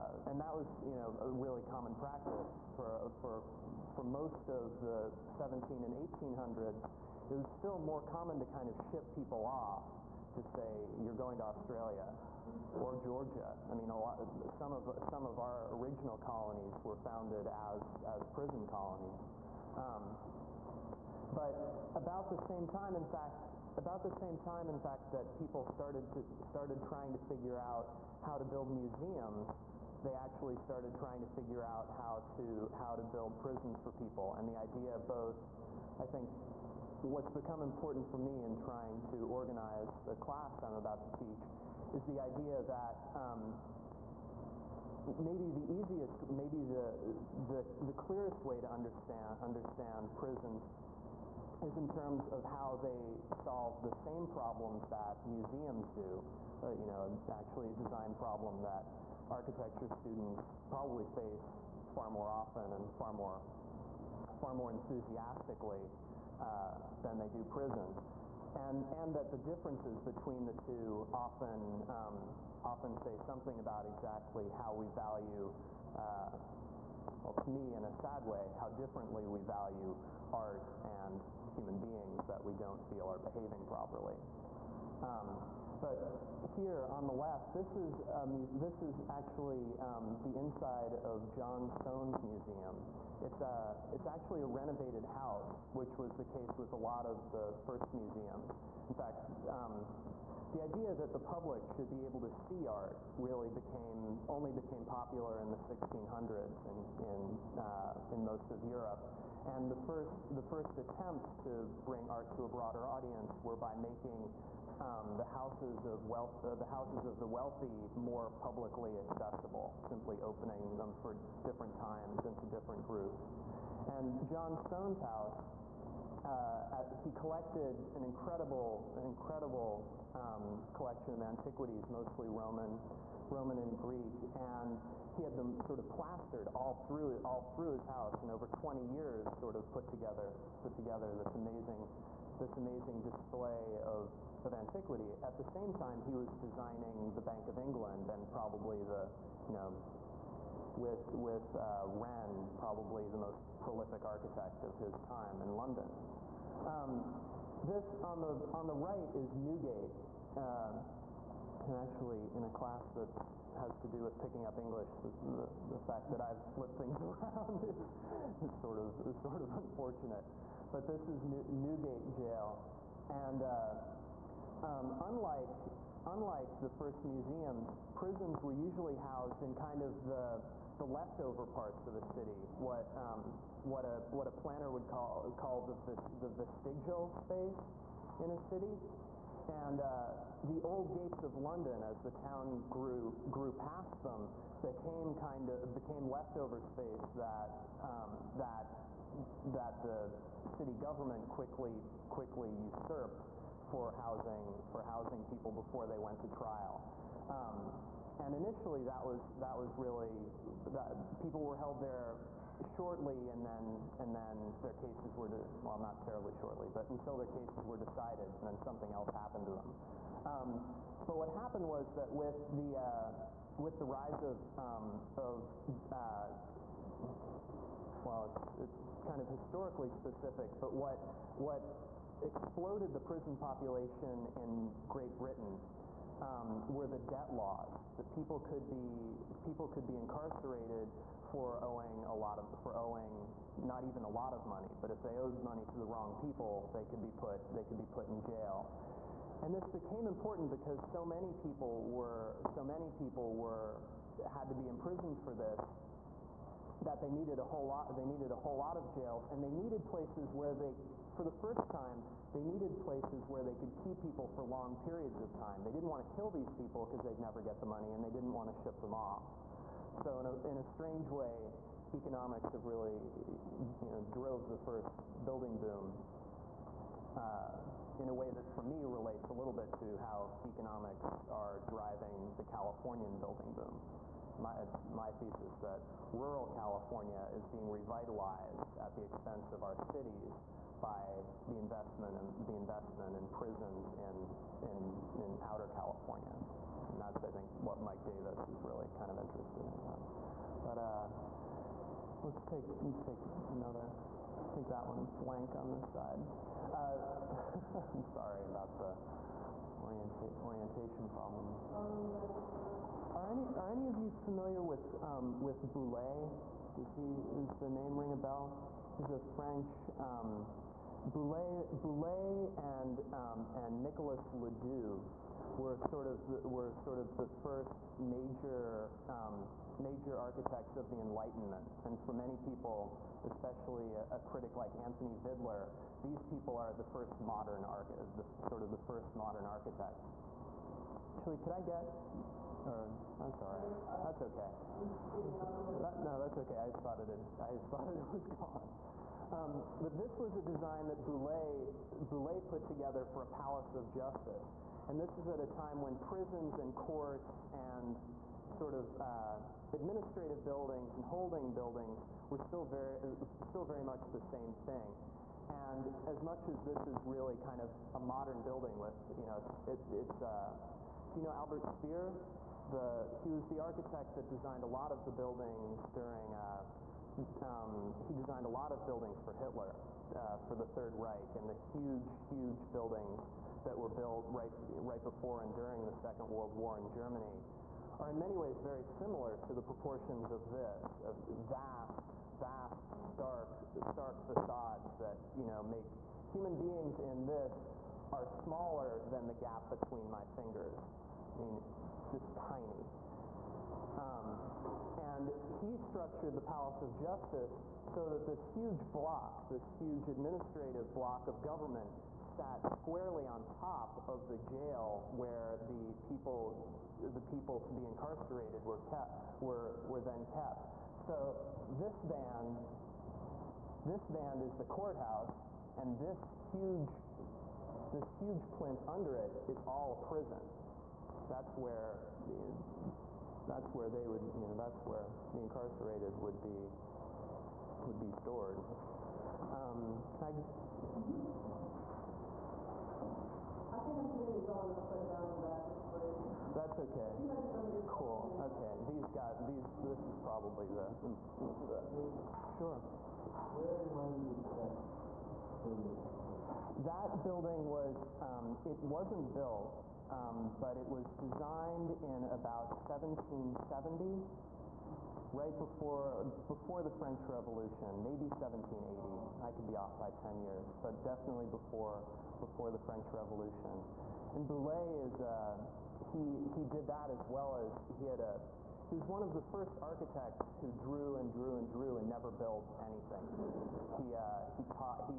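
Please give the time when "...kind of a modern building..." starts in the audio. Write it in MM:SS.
06:07.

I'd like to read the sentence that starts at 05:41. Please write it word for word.
Actually, could I get, or that's all right, that's okay.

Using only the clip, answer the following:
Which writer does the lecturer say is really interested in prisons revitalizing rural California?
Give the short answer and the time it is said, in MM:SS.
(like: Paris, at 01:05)
Mike Davis, at 04:57.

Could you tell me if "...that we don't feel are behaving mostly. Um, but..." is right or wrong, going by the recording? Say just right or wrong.
wrong.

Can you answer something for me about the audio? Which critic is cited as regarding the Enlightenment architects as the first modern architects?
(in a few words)
Anthony Vidler.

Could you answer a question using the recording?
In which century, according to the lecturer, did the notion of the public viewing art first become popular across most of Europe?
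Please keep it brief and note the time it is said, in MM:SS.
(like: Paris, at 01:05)
1600s, at 01:45.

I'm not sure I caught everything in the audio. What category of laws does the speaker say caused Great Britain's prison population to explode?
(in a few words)
debt laws.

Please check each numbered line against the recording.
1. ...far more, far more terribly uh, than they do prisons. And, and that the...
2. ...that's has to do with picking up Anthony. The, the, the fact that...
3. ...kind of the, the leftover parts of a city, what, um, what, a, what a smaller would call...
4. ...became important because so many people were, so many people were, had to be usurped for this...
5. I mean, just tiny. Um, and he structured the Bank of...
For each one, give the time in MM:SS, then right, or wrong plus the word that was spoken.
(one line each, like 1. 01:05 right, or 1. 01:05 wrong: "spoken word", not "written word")
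1. 01:02 wrong: "enthusiastically", not "terribly"
2. 02:42 wrong: "English", not "Anthony"
3. 02:59 wrong: "planner", not "smaller"
4. 04:09 wrong: "imprisoned", not "usurped"
5. 06:41 wrong: "Palace", not "Bank".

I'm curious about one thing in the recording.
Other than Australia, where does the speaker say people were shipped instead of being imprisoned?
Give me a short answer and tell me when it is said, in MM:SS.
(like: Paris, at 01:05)
Georgia, at 00:13.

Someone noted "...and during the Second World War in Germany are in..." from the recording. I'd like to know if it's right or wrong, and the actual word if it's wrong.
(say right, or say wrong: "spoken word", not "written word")
right.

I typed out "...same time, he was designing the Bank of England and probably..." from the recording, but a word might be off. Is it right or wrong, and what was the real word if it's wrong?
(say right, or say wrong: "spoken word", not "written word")
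right.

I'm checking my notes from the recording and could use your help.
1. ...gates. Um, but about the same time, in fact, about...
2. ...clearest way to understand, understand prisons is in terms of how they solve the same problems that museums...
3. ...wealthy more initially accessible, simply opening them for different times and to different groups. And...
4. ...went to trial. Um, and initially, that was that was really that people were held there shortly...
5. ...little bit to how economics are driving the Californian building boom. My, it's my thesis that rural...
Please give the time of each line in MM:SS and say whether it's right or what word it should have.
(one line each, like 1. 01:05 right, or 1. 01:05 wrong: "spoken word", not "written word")
1. 00:18 wrong: "colonies", not "gates"
2. 00:47 right
3. 01:57 wrong: "publicly", not "initially"
4. 03:25 right
5. 04:39 right.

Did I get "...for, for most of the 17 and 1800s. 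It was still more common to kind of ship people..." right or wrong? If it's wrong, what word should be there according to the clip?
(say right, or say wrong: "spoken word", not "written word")
right.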